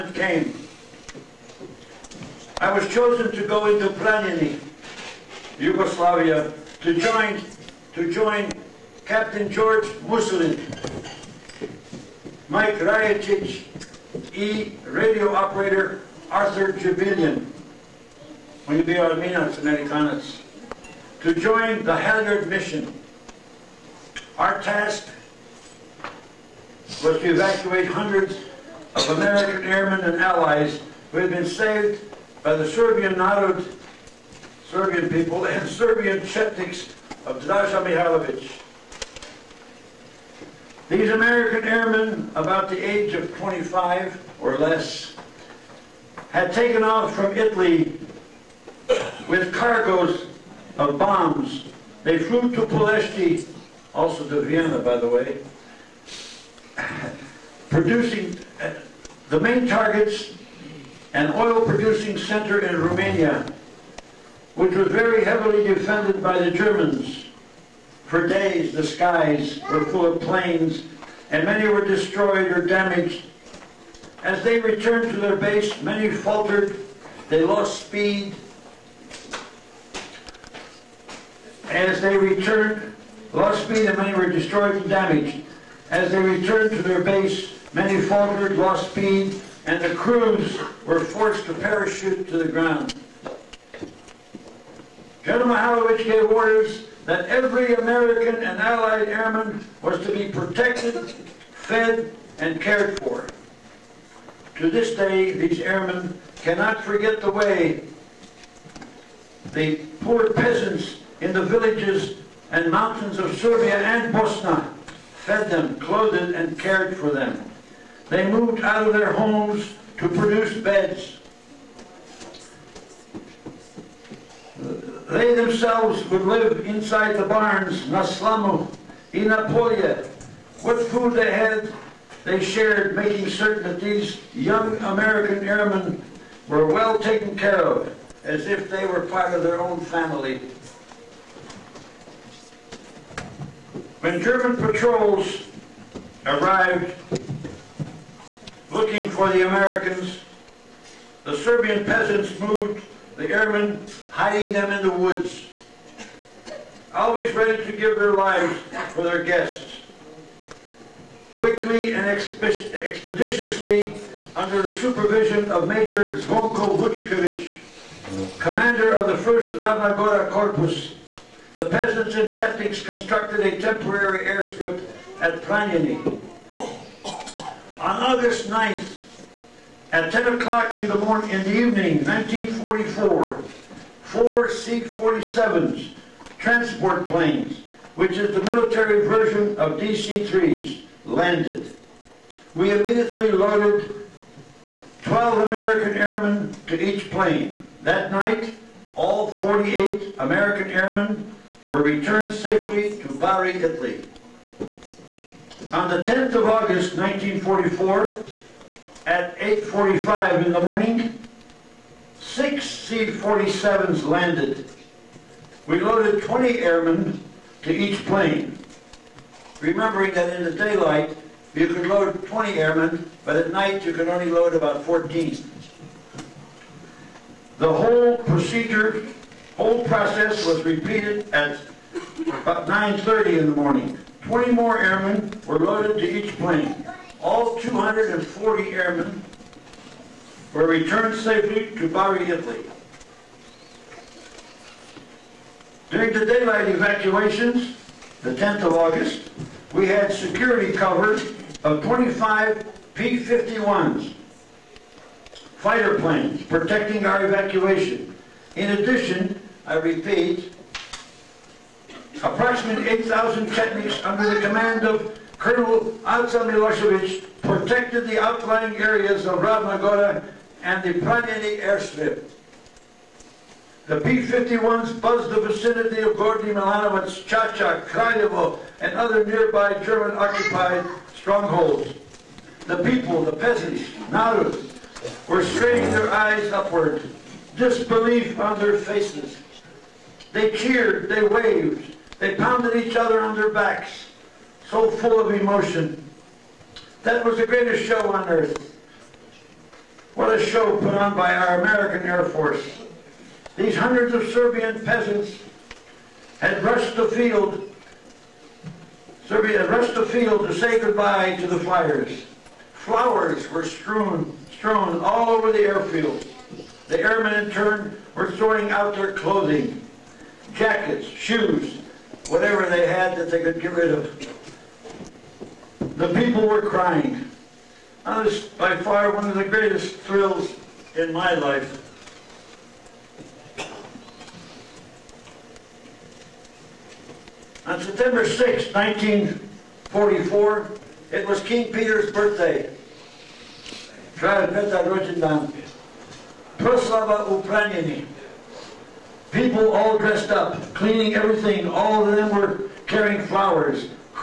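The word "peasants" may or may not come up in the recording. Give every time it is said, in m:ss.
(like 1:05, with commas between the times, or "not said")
1:50, 2:31, 2:51, 4:43, 5:04.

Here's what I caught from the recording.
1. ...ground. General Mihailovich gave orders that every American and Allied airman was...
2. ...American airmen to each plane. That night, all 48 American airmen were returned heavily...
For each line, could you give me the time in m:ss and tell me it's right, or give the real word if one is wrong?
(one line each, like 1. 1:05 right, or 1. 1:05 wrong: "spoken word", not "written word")
1. 1:32 right
2. 3:15 wrong: "safely", not "heavily".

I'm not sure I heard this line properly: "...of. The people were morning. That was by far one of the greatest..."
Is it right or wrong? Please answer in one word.
wrong.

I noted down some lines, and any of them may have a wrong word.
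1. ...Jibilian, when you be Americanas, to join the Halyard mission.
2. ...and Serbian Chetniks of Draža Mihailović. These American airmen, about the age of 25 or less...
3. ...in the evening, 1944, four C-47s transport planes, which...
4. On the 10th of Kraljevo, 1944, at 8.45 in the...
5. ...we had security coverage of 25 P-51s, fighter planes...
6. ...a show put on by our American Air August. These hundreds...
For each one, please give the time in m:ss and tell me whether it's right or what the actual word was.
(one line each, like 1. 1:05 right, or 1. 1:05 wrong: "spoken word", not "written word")
1. 0:16 right
2. 0:35 right
3. 3:01 right
4. 3:25 wrong: "August", not "Kraljevo"
5. 4:09 right
6. 5:00 wrong: "Force", not "August".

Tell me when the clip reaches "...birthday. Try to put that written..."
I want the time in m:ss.
5:42.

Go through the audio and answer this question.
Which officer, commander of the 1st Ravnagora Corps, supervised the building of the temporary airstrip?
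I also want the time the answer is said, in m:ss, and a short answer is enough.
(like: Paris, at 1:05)
Zvonko Vučković, at 2:46.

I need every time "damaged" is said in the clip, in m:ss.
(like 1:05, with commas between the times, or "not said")
1:12, 1:24.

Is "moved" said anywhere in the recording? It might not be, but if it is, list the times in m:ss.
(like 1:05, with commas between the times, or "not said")
1:58, 2:32.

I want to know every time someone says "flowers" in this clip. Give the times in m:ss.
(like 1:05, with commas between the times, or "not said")
5:12, 5:53.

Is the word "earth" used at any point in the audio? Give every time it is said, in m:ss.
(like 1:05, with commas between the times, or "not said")
4:58.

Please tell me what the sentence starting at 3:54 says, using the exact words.
20 more airmen were loaded to each plane.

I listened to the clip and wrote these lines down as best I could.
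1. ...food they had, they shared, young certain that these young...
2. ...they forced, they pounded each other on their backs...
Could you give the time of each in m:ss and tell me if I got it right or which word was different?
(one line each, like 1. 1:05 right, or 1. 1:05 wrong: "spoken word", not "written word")
1. 2:10 wrong: "making", not "young"
2. 4:51 wrong: "waved", not "forced".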